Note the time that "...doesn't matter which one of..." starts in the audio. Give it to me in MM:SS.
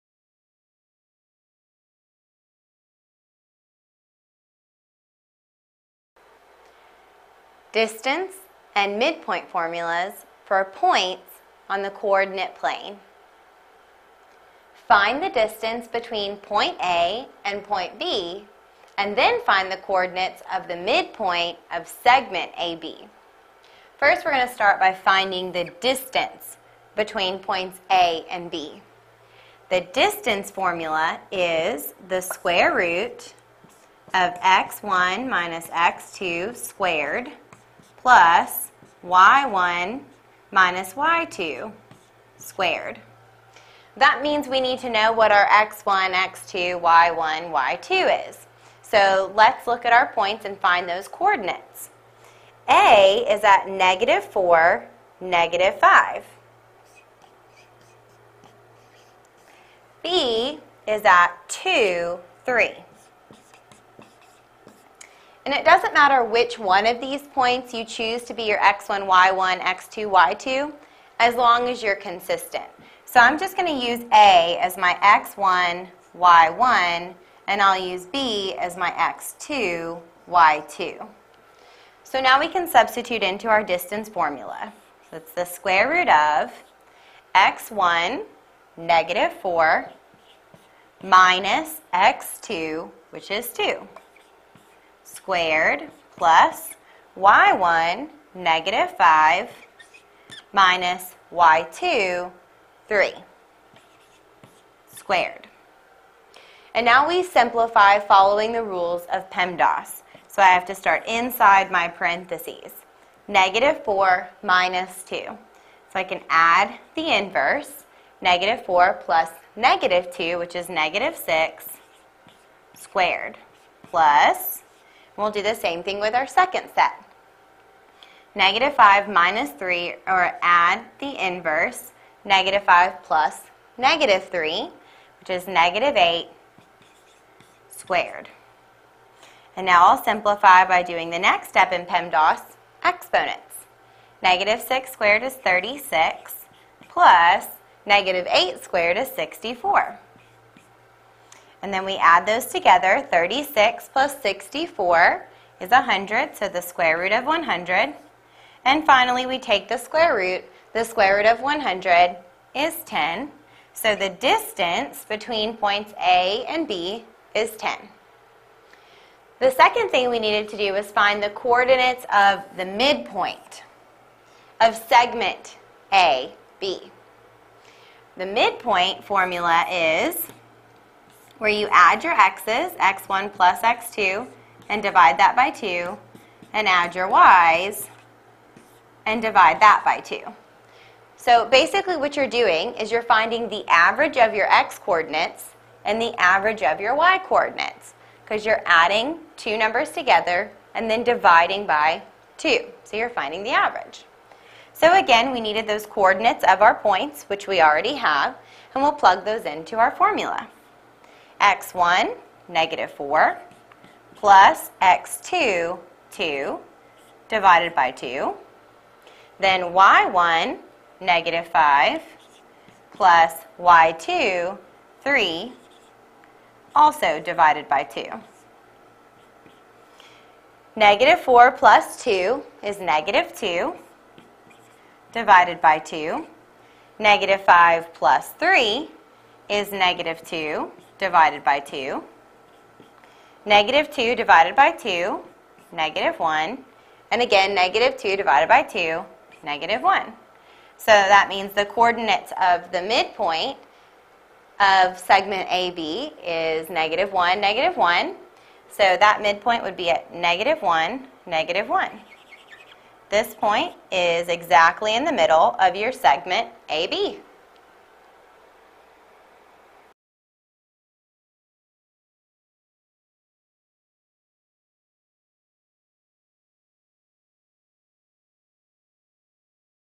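01:05.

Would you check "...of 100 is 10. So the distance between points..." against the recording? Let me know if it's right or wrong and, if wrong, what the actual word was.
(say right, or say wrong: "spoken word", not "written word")
right.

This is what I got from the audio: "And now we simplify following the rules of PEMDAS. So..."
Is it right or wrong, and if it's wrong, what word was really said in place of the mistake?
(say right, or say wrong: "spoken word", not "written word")
right.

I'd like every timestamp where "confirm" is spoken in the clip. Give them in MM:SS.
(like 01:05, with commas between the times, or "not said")
not said.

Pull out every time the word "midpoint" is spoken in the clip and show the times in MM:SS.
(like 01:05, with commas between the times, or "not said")
00:08, 00:20, 02:52, 02:58, 04:12, 04:19.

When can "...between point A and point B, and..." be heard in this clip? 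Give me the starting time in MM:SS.
00:15.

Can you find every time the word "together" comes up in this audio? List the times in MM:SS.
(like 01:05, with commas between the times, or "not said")
02:32, 03:19.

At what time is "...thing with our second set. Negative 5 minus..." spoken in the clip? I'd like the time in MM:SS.
02:05.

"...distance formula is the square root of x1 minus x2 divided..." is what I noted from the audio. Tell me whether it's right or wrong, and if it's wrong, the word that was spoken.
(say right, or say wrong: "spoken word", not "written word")
wrong: "squared", not "divided".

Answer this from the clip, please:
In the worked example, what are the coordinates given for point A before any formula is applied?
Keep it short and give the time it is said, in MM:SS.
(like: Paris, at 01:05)
(-4, -5), at 00:53.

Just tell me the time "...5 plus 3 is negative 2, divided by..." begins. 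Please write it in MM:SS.
03:57.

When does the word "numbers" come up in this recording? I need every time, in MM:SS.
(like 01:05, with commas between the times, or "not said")
03:19.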